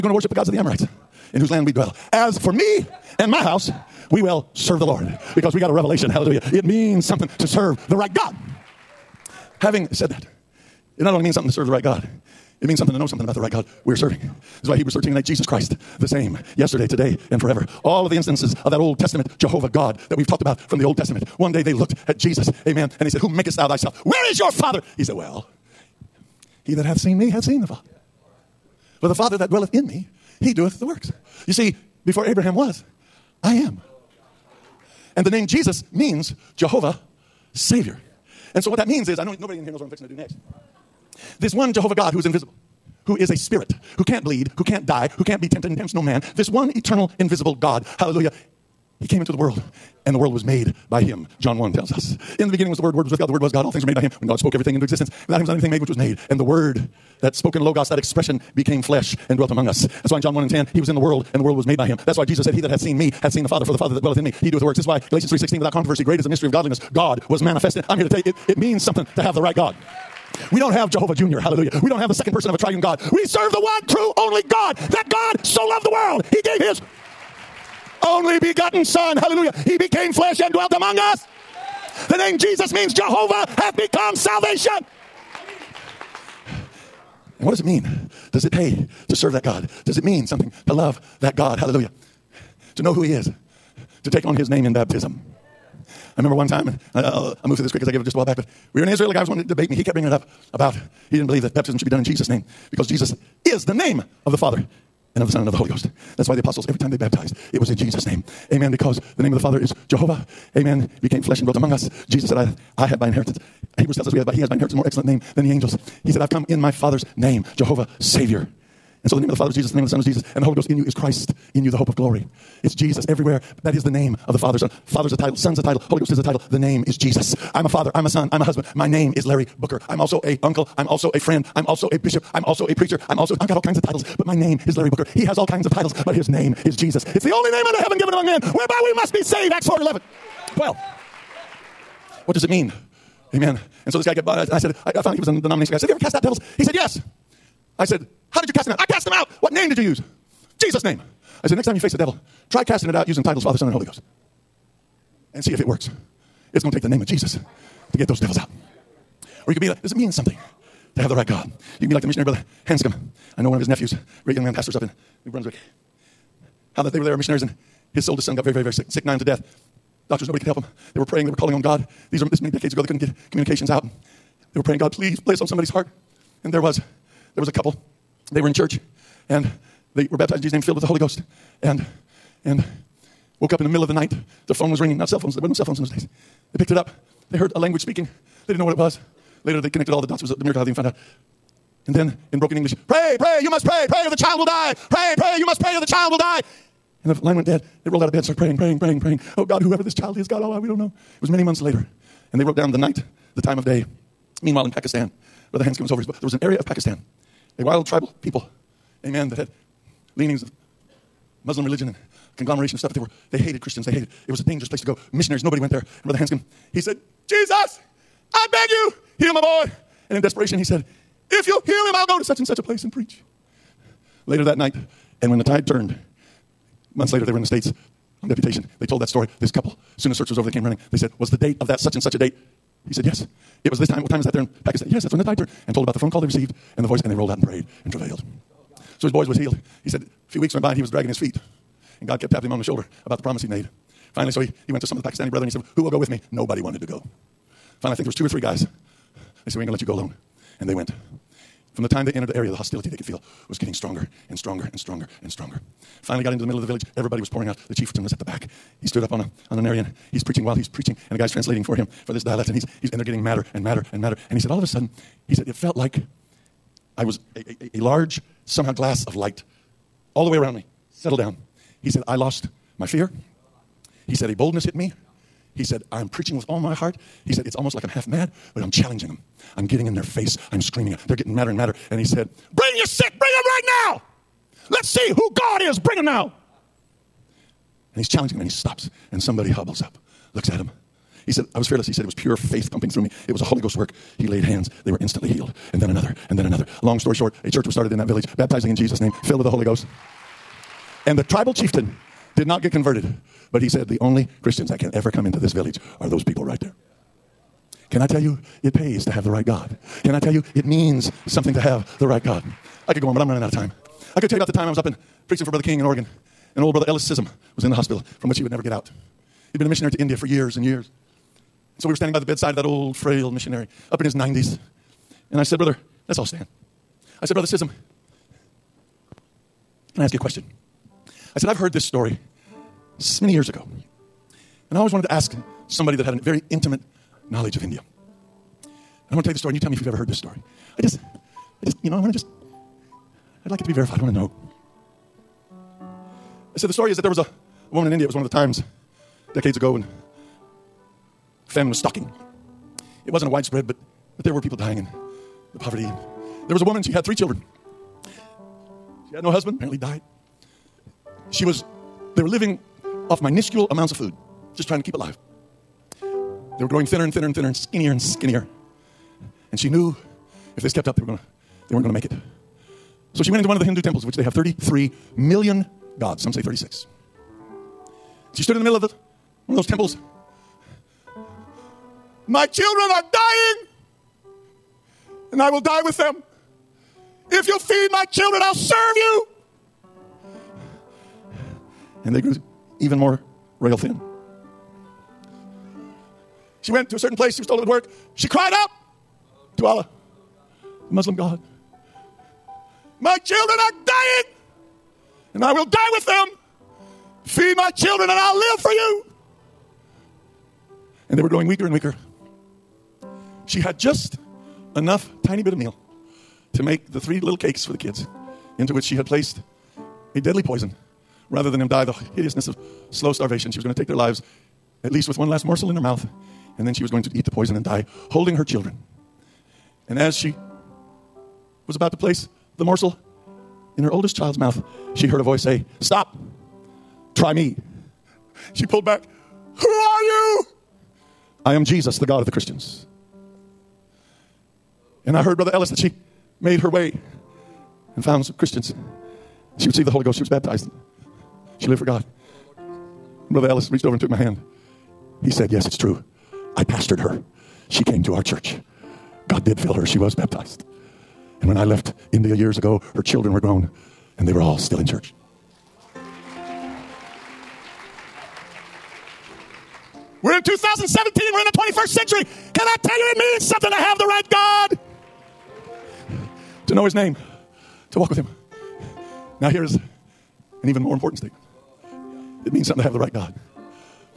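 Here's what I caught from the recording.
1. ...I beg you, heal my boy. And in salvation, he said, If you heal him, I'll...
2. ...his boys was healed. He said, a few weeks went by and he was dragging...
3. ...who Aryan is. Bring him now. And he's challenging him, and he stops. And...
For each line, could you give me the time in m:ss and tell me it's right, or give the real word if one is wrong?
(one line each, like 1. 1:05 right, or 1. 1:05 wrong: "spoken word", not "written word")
1. 3:38 wrong: "desperation", not "salvation"
2. 3:59 right
3. 4:45 wrong: "God", not "Aryan".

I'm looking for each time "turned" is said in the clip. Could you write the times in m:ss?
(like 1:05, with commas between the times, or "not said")
3:45, 3:55.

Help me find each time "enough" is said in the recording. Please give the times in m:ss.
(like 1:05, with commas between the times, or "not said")
6:54.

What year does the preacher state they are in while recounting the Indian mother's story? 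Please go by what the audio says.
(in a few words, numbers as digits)
2017.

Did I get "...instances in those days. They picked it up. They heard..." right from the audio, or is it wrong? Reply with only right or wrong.
wrong.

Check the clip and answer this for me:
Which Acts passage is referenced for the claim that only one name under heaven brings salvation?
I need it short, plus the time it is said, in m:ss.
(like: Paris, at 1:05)
Acts 4:11-12, at 2:19.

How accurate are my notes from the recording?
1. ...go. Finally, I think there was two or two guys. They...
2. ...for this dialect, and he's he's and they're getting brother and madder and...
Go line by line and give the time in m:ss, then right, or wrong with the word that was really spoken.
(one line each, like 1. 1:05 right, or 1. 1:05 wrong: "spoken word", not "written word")
1. 4:06 wrong: "three", not "two"
2. 4:22 wrong: "madder", not "brother".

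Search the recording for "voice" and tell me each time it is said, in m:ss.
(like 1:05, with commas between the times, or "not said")
3:56, 7:15.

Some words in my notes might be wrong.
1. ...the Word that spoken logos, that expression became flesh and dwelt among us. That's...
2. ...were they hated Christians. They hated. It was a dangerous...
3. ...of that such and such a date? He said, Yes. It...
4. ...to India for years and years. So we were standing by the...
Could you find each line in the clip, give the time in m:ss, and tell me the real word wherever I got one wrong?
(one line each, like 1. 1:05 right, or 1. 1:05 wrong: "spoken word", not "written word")
1. 0:56 right
2. 3:32 right
3. 3:51 right
4. 5:19 right.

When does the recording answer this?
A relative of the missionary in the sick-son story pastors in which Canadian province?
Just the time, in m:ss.
2:45.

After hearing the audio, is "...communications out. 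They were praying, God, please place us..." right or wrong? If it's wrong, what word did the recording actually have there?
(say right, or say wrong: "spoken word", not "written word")
right.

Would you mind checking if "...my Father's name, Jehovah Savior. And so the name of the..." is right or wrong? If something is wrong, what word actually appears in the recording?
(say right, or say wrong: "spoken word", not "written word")
right.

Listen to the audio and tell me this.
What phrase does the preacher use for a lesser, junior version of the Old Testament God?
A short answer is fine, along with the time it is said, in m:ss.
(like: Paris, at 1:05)
Jehovah Jr., at 1:10.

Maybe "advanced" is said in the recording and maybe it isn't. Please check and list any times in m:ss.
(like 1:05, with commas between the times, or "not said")
not said.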